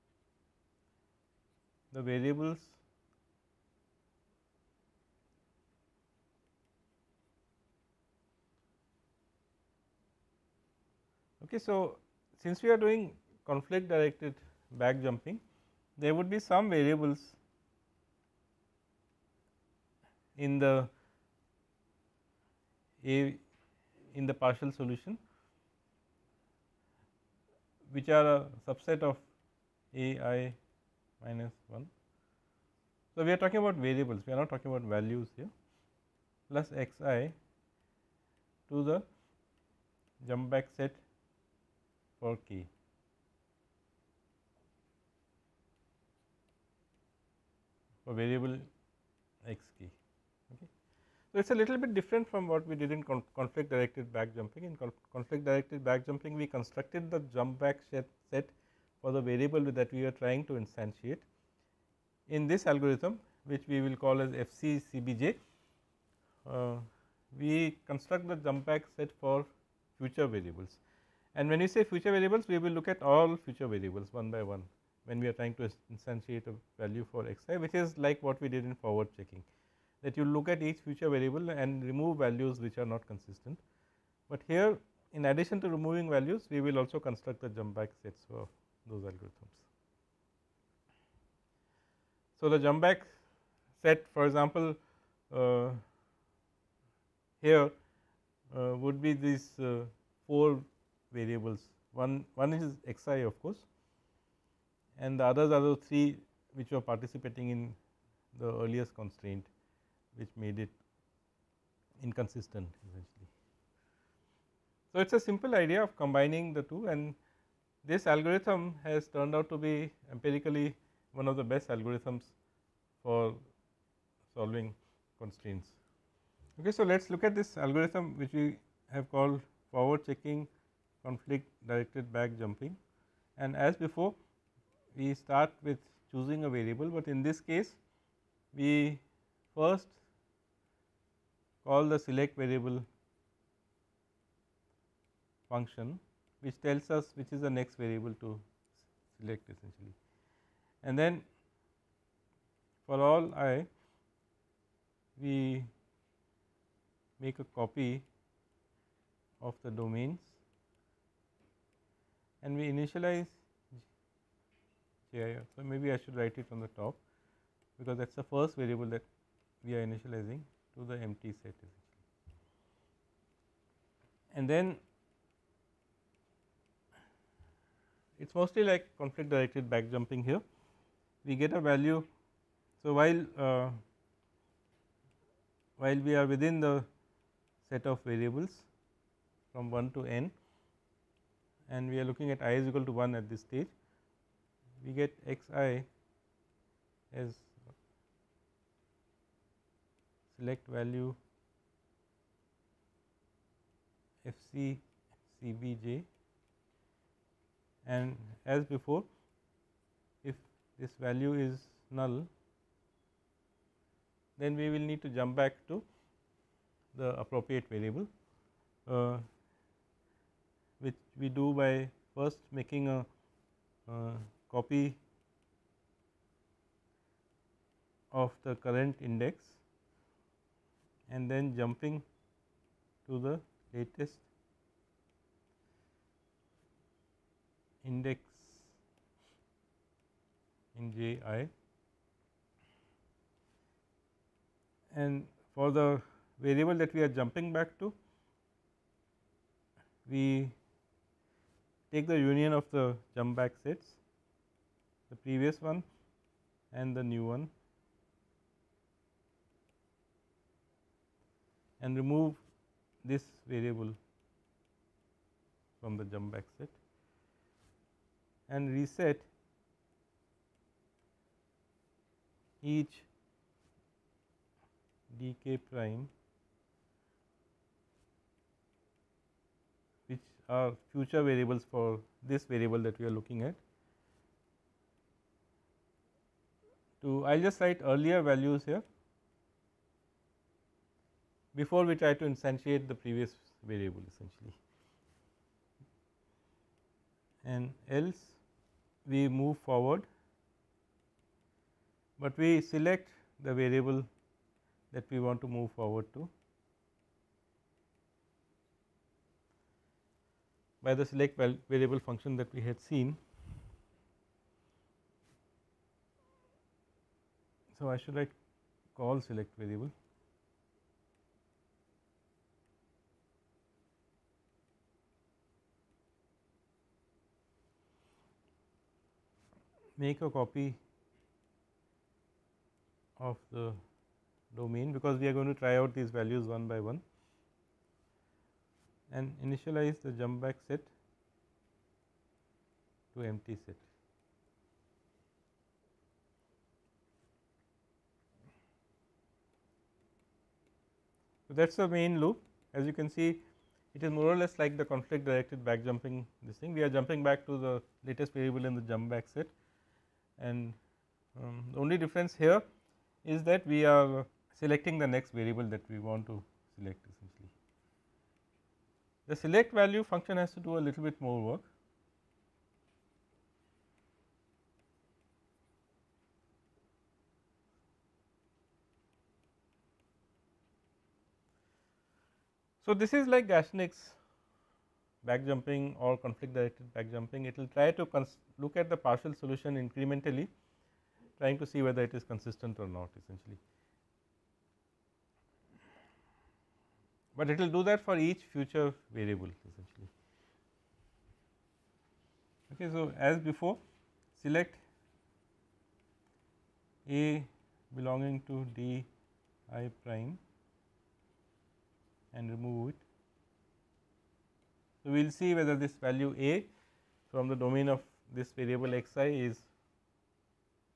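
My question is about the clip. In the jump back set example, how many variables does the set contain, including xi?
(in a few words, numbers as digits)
4.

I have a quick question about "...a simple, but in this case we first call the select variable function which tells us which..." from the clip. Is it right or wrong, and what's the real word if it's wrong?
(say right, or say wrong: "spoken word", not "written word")
wrong: "variable", not "simple".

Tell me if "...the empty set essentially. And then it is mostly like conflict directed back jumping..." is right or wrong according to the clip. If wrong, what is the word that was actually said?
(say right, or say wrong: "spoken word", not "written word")
right.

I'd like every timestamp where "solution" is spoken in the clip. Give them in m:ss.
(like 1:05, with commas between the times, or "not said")
0:24, 6:29.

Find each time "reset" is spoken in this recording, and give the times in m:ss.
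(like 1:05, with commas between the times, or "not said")
4:28.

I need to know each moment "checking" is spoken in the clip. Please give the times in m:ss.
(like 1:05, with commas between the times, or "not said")
1:19, 2:10.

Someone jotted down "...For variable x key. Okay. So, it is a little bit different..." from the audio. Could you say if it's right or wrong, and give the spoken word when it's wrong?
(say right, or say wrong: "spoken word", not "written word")
right.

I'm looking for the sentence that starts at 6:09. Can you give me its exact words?
The select value function has to do a little bit more work.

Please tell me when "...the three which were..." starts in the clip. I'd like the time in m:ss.
1:45.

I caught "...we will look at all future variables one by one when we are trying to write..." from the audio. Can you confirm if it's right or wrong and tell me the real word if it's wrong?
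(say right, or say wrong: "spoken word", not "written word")
wrong: "instantiate", not "write".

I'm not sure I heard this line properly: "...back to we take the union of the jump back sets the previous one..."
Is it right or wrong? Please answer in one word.
right.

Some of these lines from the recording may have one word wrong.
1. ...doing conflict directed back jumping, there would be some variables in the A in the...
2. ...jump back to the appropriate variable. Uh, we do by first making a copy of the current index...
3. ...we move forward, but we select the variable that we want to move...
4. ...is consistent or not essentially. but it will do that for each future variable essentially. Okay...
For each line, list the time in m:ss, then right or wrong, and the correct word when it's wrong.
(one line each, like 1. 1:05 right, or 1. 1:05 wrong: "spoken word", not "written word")
1. 0:12 right
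2. 3:35 right
3. 4:59 right
4. 6:32 right.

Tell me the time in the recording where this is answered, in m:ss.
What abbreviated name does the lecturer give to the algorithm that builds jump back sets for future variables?
1:04.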